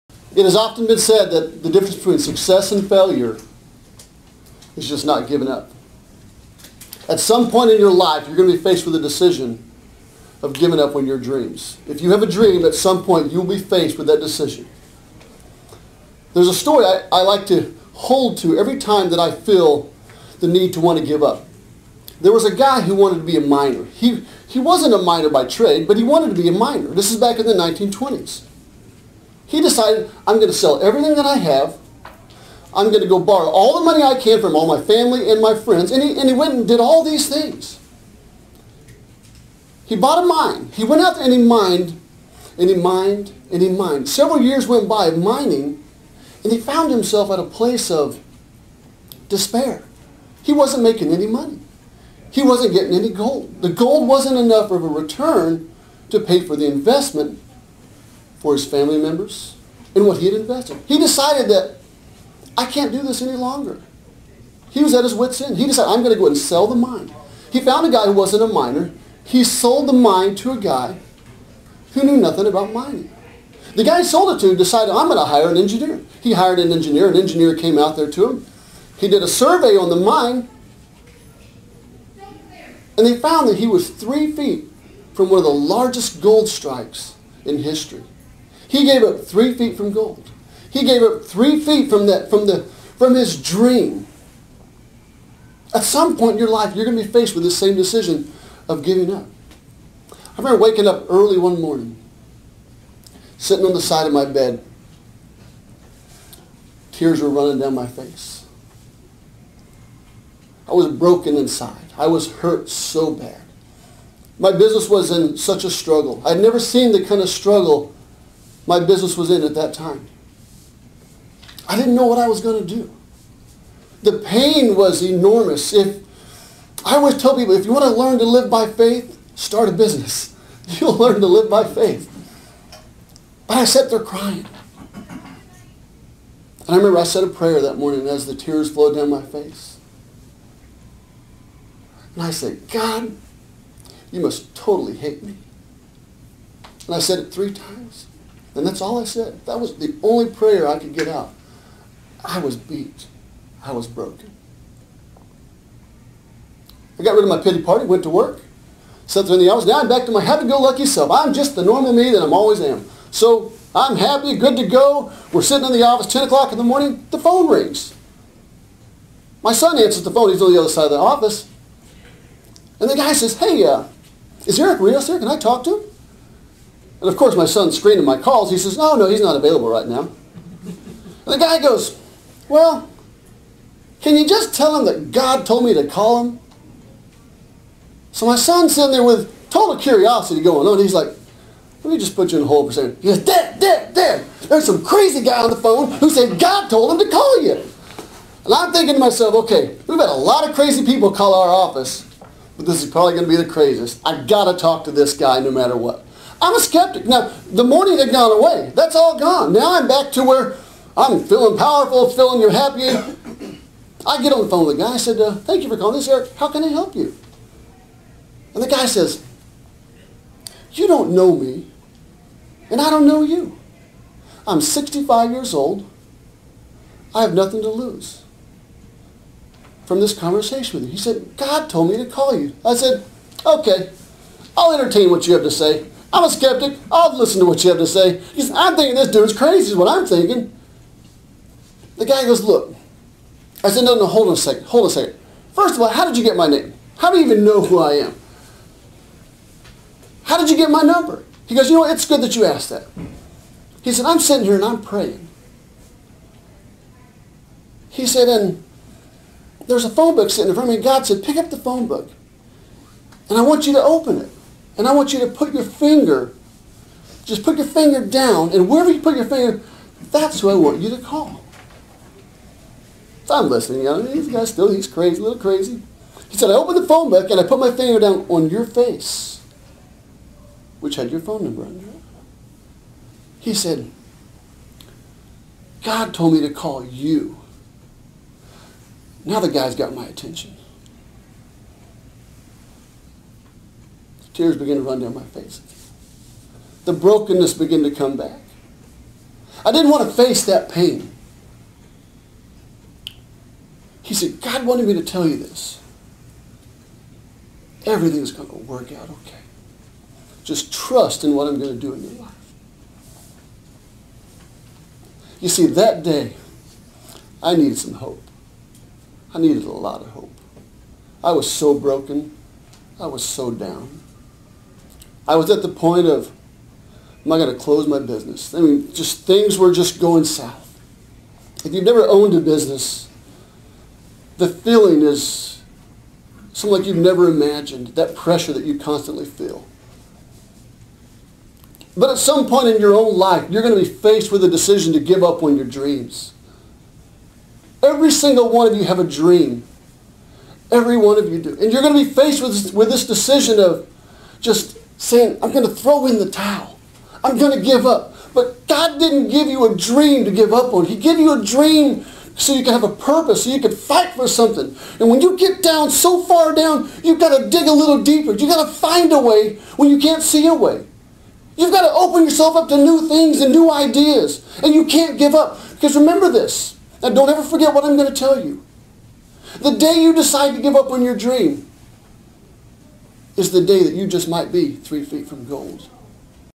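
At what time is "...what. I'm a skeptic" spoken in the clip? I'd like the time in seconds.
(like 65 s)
205 s.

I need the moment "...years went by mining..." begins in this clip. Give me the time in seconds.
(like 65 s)
44 s.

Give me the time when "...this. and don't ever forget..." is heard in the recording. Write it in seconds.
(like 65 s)
376 s.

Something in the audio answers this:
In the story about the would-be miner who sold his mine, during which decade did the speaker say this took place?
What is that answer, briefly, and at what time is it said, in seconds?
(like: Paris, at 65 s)
1920s, at 27 s.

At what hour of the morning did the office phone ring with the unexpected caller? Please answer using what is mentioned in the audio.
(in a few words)
10 o'clock.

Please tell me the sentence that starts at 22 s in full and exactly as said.
There was a guy who wanted to be a miner.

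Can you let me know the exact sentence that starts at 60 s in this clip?
He decided that I can't do this any longer.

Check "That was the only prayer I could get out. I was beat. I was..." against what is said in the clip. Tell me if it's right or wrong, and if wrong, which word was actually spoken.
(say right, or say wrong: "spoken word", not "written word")
right.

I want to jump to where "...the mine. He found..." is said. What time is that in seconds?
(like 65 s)
66 s.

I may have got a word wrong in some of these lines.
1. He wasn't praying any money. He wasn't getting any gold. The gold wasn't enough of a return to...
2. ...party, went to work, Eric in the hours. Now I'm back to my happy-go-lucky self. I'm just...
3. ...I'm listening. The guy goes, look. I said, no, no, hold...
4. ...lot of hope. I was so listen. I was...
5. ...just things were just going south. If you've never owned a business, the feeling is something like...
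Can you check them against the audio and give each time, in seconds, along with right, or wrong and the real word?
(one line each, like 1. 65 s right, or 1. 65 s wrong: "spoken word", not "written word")
1. 50 s wrong: "making", not "praying"
2. 157 s wrong: "Sat", not "Eric"
3. 239 s wrong: "thinking", not "listening"
4. 319 s wrong: "broken", not "listen"
5. 328 s right.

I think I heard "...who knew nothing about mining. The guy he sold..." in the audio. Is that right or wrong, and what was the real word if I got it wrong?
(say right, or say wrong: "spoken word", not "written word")
right.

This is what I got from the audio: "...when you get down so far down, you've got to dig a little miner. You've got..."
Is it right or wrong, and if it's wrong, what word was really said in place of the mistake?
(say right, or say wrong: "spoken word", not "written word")
wrong: "deeper", not "miner".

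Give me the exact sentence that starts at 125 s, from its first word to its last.
If I always tell people, if you want to learn to live by faith, start a business.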